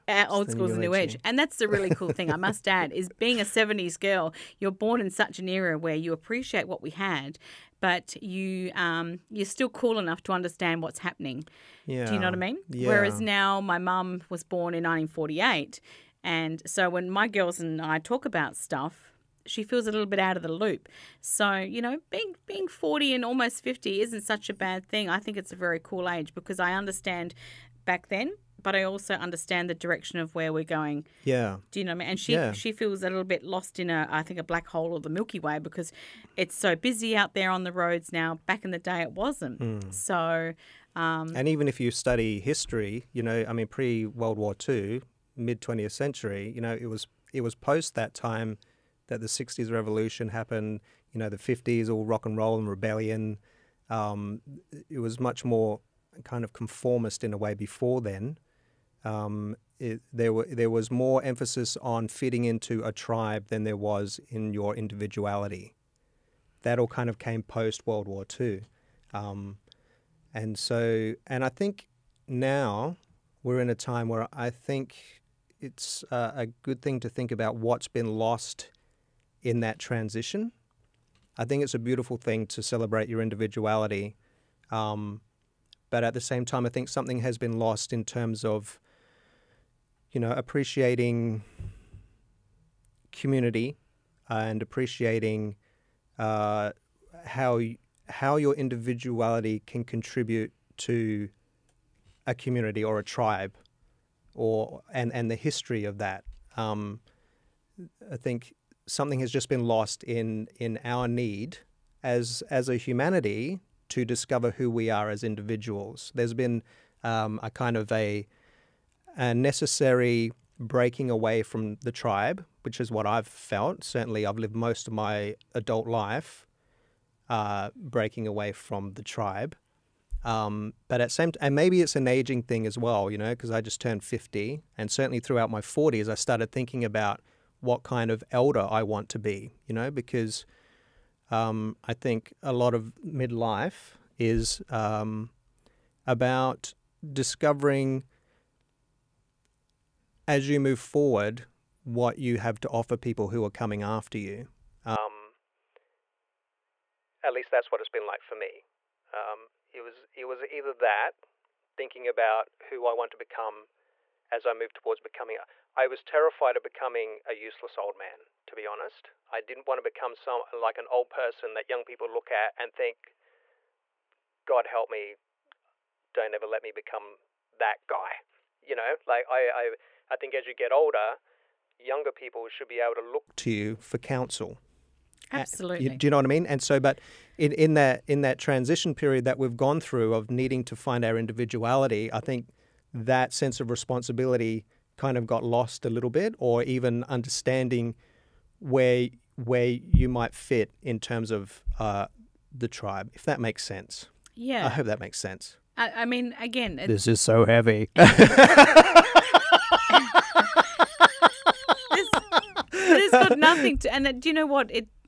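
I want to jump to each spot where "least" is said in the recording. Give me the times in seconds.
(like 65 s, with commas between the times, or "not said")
157 s.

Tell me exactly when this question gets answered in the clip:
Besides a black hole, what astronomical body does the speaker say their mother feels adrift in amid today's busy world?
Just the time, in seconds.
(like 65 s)
35 s.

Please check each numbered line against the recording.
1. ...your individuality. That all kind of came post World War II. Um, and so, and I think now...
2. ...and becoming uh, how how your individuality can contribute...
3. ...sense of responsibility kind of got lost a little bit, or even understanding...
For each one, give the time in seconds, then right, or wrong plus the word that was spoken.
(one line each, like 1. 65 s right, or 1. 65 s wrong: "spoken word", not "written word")
1. 64 s right
2. 94 s wrong: "appreciating", not "becoming"
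3. 193 s right.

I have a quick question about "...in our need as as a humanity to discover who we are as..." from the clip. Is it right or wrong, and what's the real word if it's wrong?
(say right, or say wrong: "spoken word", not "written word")
right.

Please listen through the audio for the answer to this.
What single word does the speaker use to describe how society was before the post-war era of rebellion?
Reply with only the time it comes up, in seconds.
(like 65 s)
56 s.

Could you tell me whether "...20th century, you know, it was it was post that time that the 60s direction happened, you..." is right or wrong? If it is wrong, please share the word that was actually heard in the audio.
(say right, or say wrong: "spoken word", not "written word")
wrong: "revolution", not "direction".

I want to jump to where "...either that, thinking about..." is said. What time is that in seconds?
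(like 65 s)
160 s.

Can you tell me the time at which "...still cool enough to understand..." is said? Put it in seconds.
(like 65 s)
9 s.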